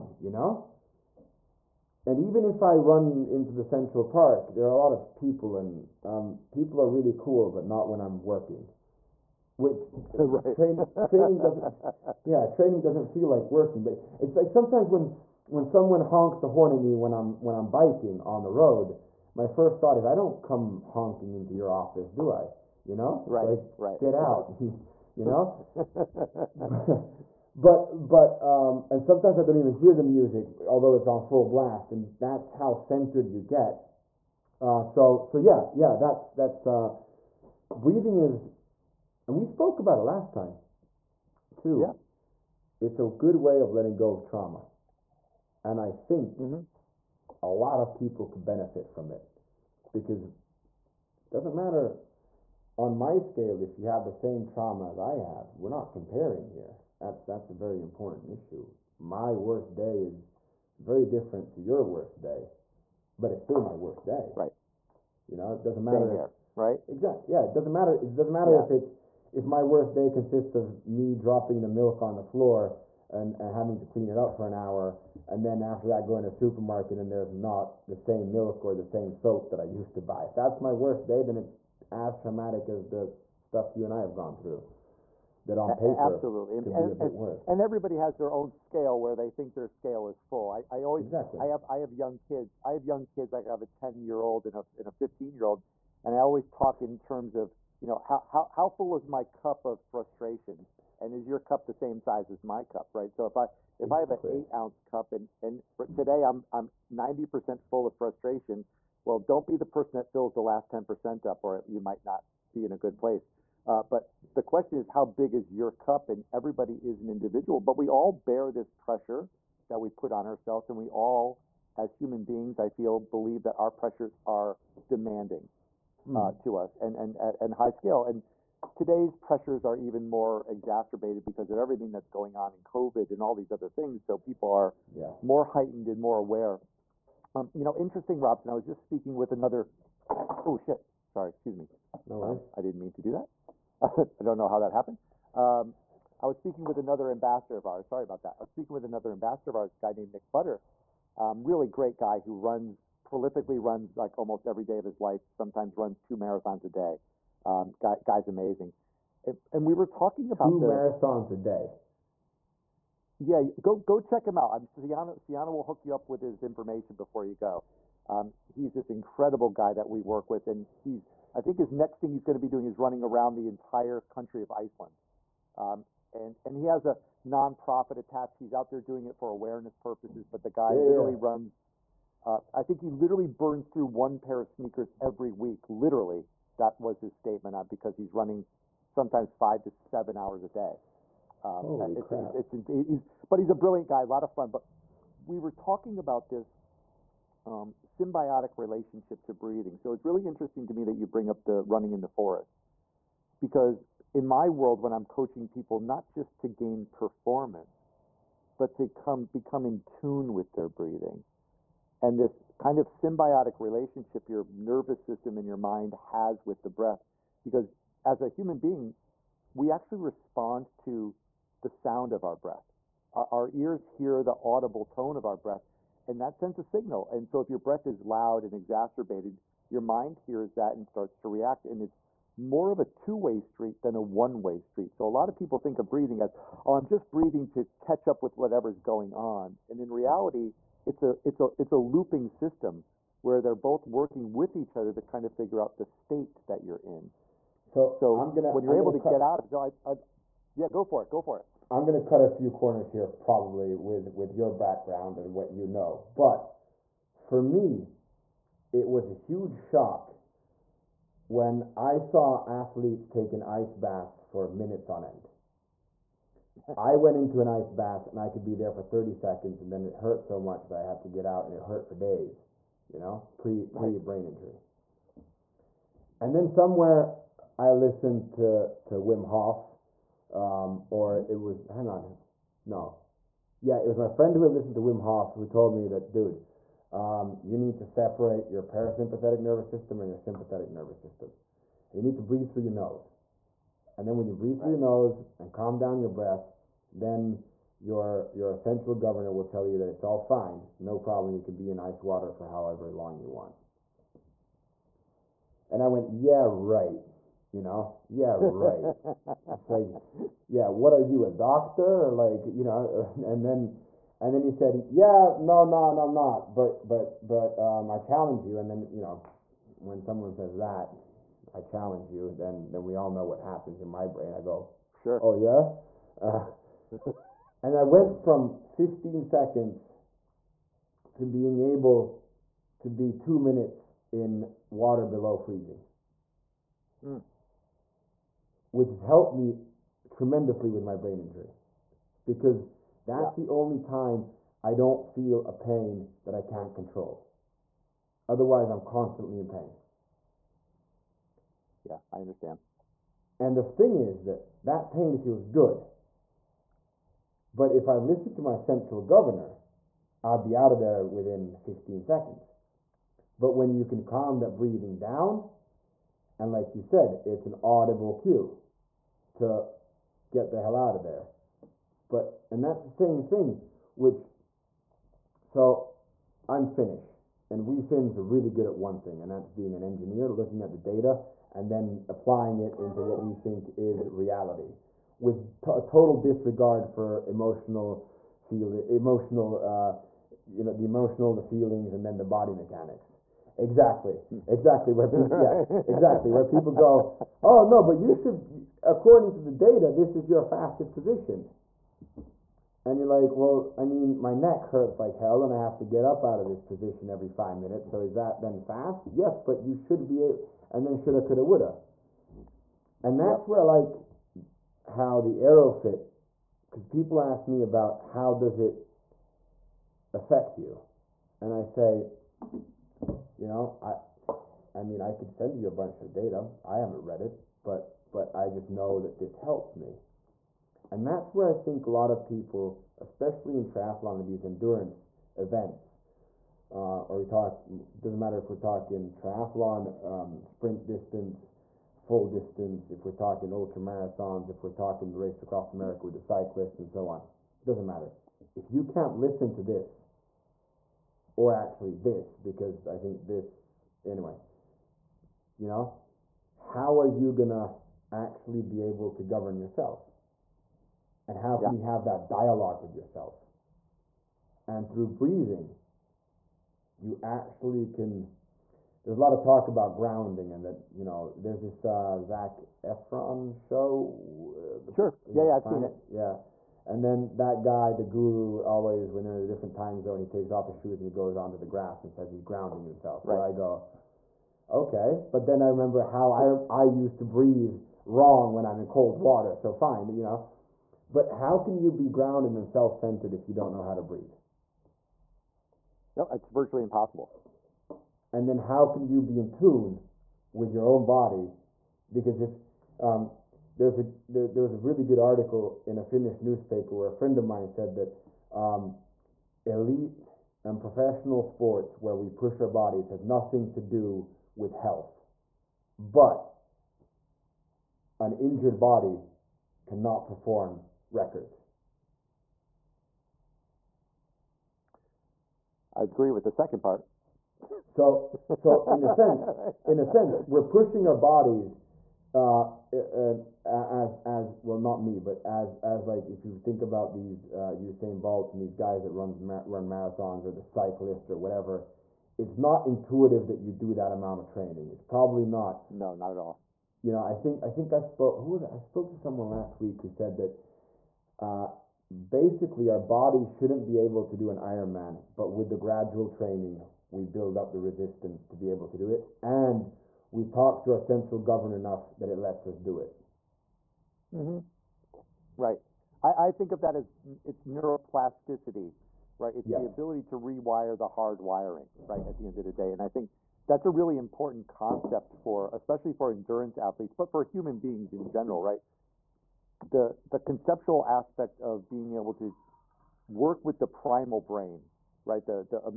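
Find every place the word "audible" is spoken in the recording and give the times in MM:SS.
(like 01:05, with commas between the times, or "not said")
03:44, 06:07.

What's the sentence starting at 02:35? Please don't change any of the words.
Sometimes runs two marathons a day.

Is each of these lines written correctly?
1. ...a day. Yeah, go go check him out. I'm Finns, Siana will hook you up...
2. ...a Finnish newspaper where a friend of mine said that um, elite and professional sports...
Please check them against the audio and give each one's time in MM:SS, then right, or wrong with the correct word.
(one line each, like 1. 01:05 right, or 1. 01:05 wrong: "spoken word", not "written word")
1. 02:41 wrong: "Siana", not "Finns"
2. 08:25 right.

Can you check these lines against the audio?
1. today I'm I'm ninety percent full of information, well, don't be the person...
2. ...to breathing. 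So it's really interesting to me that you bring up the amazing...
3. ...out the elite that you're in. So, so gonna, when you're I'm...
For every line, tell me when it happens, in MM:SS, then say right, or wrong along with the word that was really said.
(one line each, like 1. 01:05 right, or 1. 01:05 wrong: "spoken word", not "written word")
1. 01:45 wrong: "frustration", not "information"
2. 03:19 wrong: "running", not "amazing"
3. 04:05 wrong: "state", not "elite".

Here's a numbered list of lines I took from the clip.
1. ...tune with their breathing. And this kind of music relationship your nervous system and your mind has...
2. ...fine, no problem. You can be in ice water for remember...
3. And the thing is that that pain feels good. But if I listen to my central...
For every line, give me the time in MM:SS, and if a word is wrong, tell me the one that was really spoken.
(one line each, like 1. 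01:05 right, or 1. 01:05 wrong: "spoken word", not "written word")
1. 03:29 wrong: "symbiotic", not "music"
2. 05:00 wrong: "however", not "remember"
3. 05:53 right.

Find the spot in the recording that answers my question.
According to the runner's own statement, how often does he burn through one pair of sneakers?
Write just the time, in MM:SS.
03:04.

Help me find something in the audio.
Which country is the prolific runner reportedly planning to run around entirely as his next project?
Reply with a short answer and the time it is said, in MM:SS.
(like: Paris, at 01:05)
Iceland, at 02:54.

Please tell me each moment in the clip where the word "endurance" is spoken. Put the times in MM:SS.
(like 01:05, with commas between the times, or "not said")
07:14, 09:36.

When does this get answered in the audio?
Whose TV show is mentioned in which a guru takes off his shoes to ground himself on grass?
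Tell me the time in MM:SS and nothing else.
07:52.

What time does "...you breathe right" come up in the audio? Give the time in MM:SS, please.
04:54.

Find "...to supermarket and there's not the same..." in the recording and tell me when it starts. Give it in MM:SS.
01:16.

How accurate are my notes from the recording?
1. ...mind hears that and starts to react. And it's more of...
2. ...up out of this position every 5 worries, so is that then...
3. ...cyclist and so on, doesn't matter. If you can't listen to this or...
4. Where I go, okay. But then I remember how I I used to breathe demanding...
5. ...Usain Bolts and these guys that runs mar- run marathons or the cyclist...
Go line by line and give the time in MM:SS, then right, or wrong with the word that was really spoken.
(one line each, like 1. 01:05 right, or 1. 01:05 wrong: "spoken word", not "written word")
1. 03:49 right
2. 06:46 wrong: "minutes", not "worries"
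3. 07:26 right
4. 08:03 wrong: "wrong", not "demanding"
5. 08:57 right.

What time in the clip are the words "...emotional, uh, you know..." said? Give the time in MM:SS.
06:28.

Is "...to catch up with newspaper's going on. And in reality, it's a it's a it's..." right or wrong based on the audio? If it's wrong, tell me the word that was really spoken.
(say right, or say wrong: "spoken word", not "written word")
wrong: "whatever", not "newspaper".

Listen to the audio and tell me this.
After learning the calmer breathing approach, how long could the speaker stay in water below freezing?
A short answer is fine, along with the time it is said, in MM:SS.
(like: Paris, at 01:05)
2 minutes, at 05:33.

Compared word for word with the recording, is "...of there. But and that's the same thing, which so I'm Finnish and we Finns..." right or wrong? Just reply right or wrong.
right.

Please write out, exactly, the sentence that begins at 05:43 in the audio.
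the only time I don't feel a pain that I can't control.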